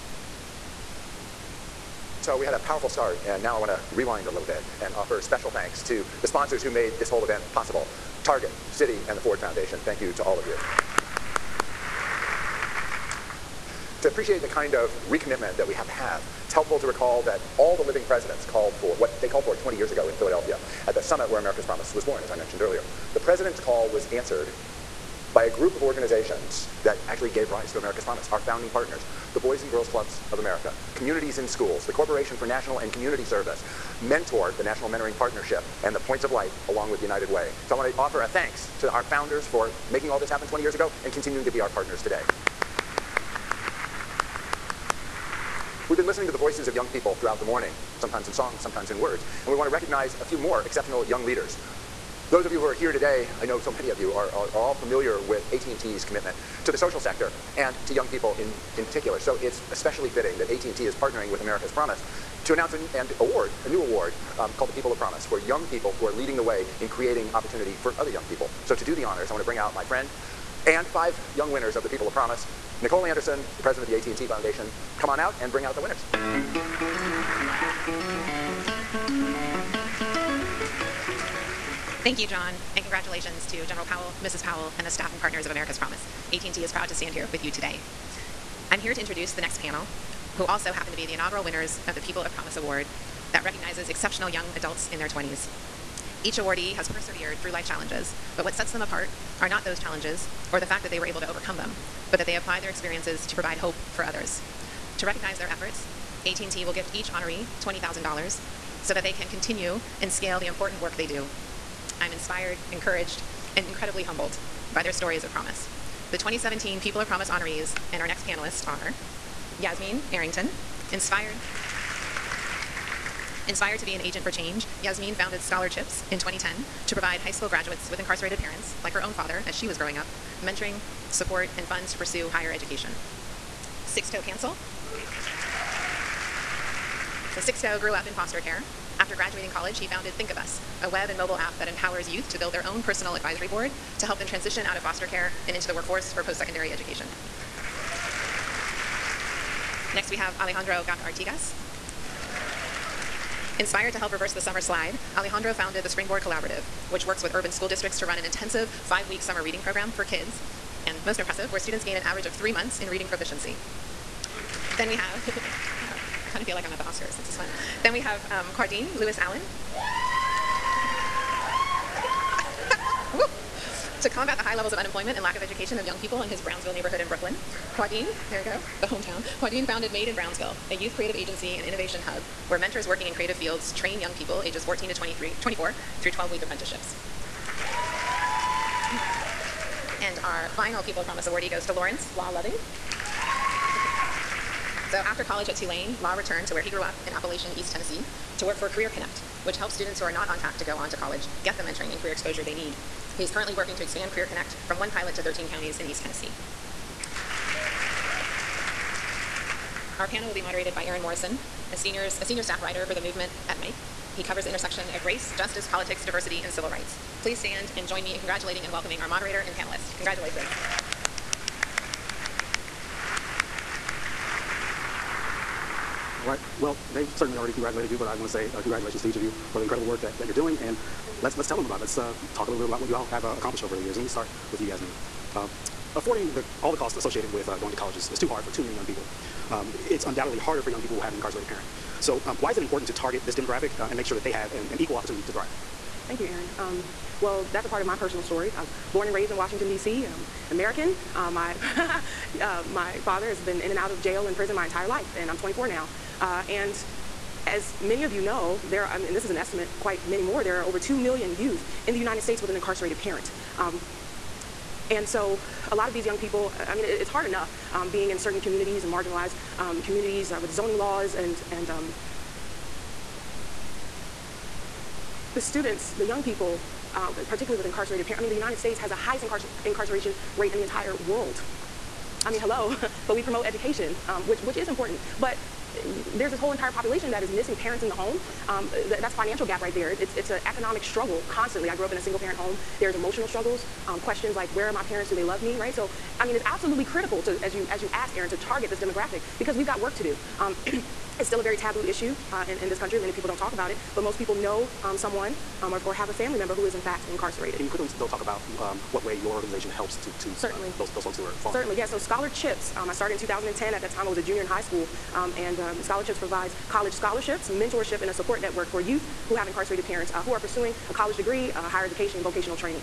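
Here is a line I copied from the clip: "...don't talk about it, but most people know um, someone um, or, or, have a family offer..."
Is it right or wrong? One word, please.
wrong.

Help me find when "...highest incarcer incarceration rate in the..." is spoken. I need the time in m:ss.
4:38.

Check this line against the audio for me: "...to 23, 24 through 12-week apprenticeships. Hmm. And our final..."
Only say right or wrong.
right.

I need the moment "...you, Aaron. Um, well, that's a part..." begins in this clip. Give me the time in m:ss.
4:06.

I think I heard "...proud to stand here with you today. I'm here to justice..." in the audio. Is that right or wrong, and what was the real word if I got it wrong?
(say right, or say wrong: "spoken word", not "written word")
wrong: "introduce", not "justice".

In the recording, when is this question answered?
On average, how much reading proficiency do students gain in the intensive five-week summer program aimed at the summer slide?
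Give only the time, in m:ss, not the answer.
2:42.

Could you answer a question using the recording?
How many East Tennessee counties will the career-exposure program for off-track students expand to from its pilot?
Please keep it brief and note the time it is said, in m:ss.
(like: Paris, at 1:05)
13, at 3:25.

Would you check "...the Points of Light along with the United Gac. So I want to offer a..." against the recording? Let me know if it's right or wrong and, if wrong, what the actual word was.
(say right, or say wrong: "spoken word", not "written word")
wrong: "Way", not "Gac".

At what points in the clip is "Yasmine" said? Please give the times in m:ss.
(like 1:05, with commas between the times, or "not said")
1:59, 2:04, 3:54.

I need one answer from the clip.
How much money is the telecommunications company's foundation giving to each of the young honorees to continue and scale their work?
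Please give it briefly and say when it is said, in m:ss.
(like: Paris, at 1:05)
$20,000, at 1:47.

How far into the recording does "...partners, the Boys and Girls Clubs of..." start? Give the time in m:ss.
0:28.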